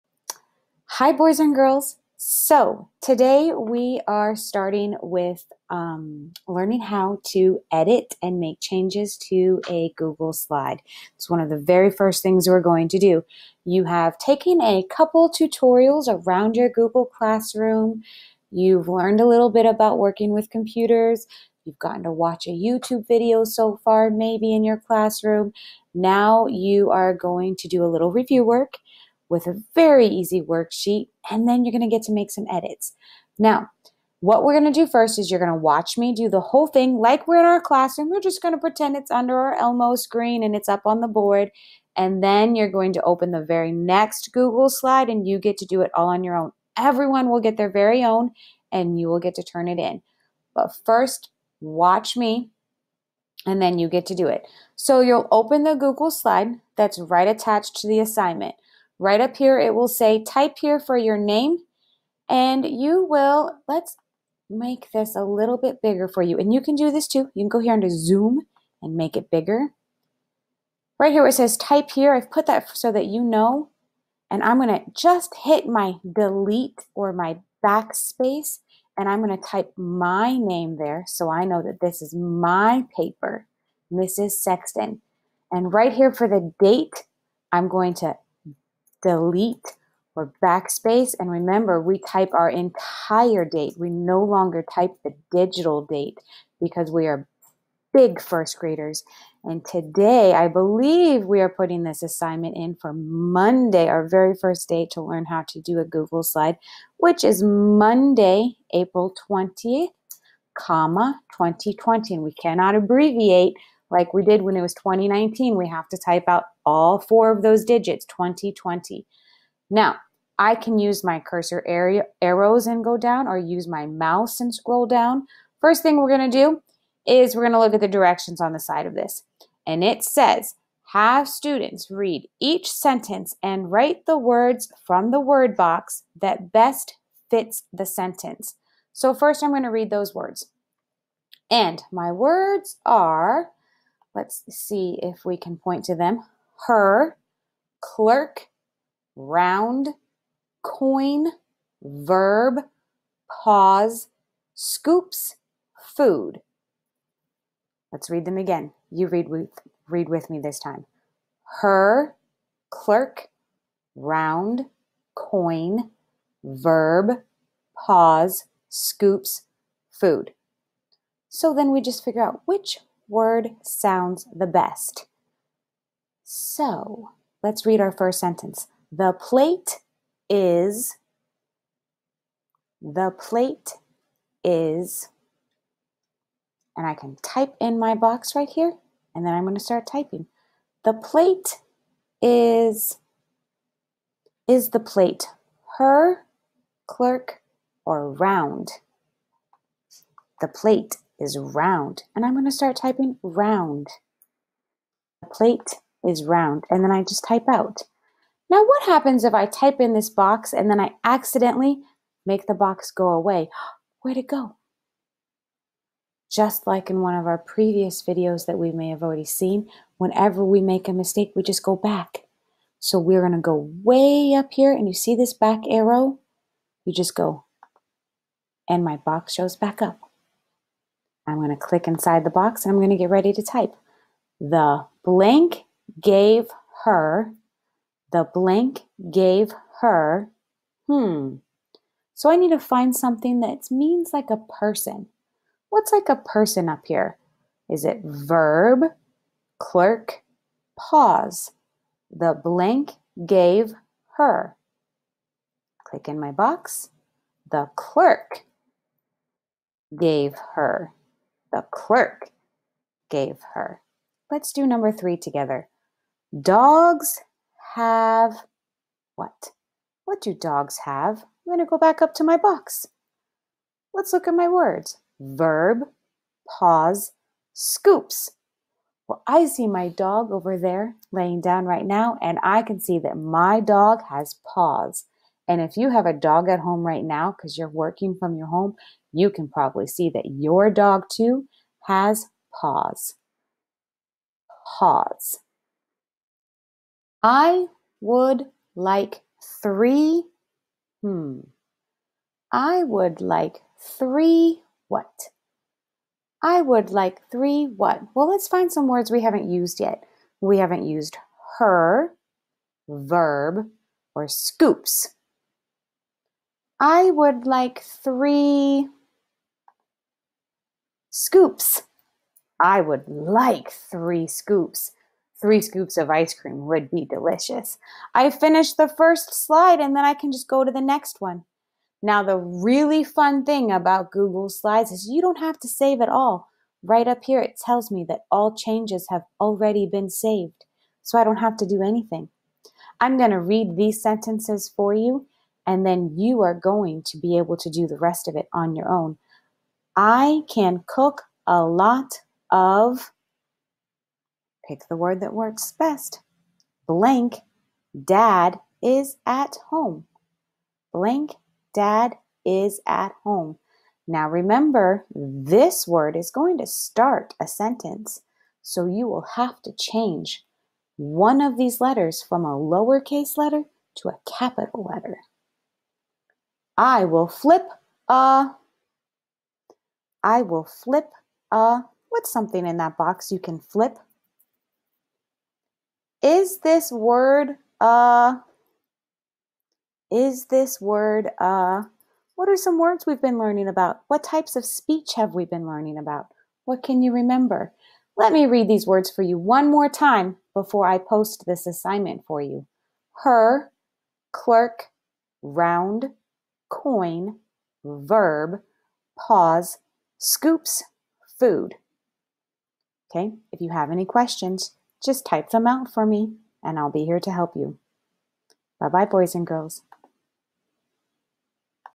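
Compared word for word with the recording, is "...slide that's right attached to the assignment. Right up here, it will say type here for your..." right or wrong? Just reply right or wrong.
right.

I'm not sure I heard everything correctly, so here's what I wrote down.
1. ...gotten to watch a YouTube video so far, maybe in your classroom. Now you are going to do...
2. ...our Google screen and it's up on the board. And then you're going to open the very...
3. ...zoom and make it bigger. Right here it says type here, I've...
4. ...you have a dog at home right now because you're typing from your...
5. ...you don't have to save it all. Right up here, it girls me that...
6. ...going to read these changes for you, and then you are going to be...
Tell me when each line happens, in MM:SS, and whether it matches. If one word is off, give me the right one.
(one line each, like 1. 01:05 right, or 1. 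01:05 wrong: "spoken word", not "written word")
1. 00:21 right
2. 00:39 wrong: "Elmo", not "Google"
3. 01:07 right
4. 04:45 wrong: "working", not "typing"
5. 05:35 wrong: "tells", not "girls"
6. 05:43 wrong: "sentences", not "changes".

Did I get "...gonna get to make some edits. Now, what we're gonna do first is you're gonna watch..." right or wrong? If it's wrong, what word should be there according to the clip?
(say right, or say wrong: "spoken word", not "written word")
right.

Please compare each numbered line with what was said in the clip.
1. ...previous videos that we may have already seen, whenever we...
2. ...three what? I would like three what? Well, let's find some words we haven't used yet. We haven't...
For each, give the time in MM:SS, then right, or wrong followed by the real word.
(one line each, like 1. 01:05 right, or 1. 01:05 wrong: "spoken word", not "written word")
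1. 03:37 right
2. 05:03 right.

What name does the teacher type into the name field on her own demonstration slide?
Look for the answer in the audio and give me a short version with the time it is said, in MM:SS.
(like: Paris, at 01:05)
Mrs. Sexton, at 01:23.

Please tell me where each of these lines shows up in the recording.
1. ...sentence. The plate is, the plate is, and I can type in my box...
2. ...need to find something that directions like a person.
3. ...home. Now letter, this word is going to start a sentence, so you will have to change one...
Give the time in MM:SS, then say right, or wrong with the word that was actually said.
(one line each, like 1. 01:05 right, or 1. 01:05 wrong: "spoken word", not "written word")
1. 02:58 right
2. 04:02 wrong: "means", not "directions"
3. 06:03 wrong: "remember", not "letter".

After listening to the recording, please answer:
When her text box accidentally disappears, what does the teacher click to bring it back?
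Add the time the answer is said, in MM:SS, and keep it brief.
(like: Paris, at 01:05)
back arrow, at 03:45.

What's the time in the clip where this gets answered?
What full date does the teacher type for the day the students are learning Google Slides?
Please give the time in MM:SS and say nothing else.
01:47.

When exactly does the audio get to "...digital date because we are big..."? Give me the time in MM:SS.
01:35.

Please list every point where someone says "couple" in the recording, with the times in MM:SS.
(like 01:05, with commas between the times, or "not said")
00:14.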